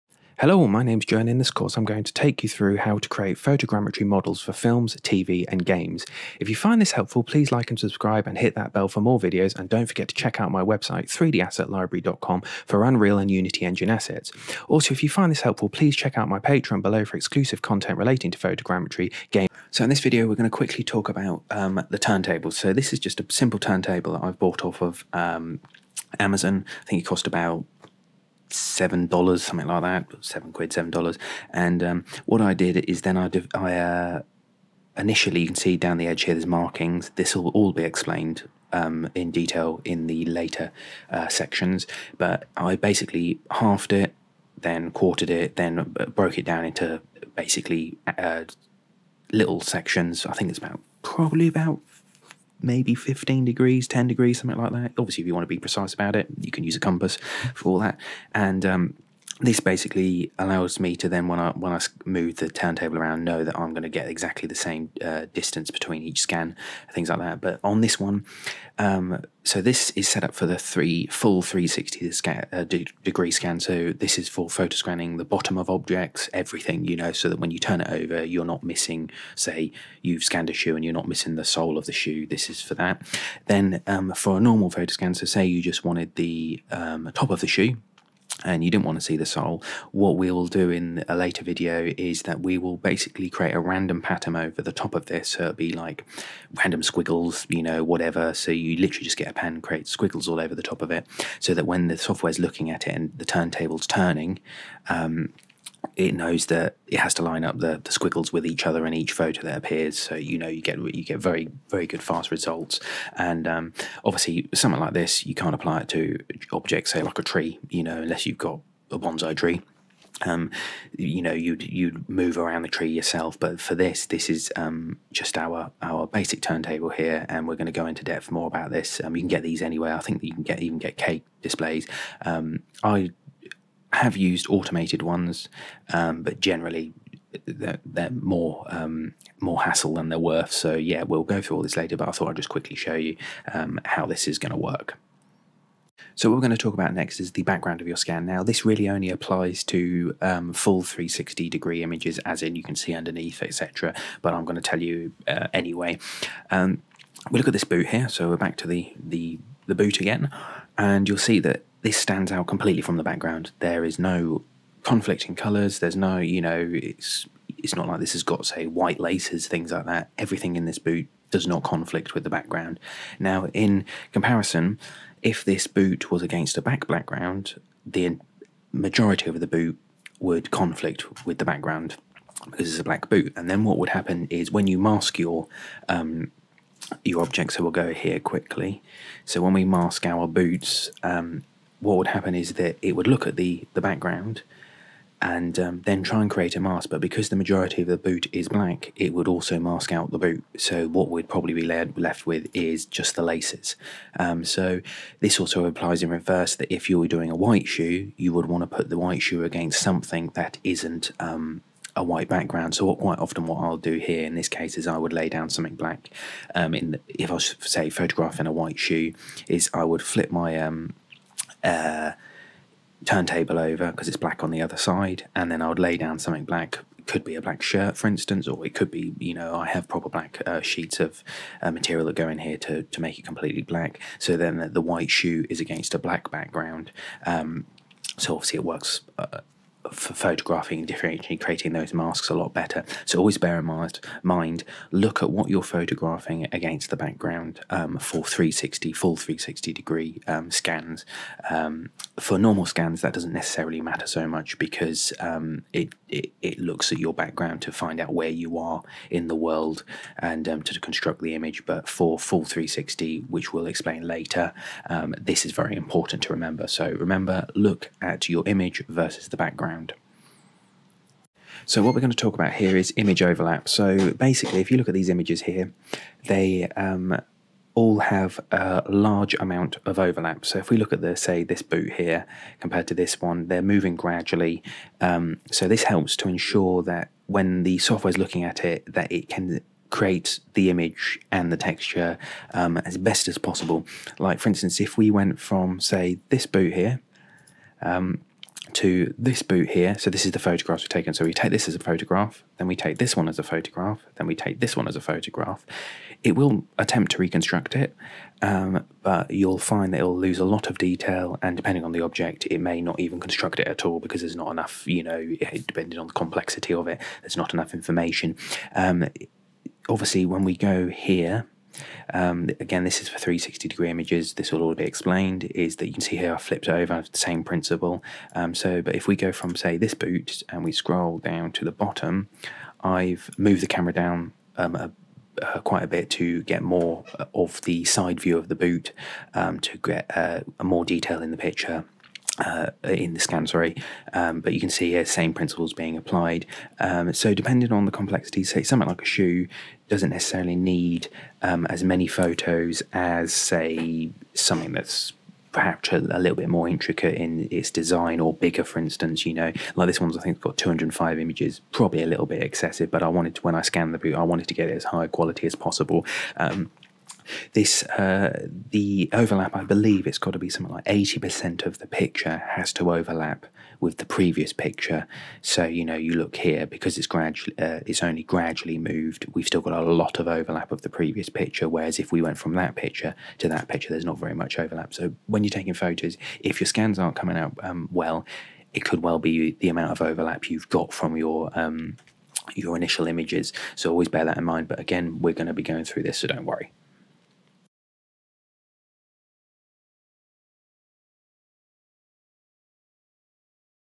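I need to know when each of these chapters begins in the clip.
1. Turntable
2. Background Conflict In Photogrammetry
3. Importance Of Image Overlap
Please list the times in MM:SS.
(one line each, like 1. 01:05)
1. 00:22
2. 02:25
3. 04:30.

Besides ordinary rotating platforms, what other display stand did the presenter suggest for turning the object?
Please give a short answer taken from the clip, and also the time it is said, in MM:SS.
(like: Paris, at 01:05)
cake displays, at 02:10.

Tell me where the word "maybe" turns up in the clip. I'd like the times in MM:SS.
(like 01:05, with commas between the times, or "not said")
00:52.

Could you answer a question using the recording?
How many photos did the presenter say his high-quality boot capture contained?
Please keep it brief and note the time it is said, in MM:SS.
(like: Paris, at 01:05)
205, at 06:00.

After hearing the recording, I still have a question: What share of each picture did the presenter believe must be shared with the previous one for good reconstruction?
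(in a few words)
80%.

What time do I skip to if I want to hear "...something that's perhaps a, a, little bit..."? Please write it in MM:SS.
05:54.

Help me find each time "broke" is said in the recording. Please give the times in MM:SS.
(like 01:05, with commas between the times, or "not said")
00:46.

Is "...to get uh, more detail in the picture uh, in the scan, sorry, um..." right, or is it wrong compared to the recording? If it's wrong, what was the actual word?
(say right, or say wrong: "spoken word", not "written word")
right.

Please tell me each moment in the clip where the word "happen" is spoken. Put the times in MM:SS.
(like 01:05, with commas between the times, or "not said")
03:03, 03:12.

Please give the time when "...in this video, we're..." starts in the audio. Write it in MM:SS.
00:19.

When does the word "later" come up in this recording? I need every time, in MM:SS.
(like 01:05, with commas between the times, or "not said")
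00:40, 01:31, 02:21, 04:24.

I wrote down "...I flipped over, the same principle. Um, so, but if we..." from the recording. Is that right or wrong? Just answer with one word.
right.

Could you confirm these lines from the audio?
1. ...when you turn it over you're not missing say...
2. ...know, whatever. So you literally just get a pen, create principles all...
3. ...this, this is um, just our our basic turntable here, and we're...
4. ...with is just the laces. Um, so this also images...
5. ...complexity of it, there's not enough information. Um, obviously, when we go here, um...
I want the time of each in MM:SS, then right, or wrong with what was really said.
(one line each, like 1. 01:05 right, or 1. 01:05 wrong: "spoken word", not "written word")
1. 01:17 right
2. 01:37 wrong: "squiggles", not "principles"
3. 02:03 right
4. 03:22 wrong: "applies", not "images"
5. 05:16 right.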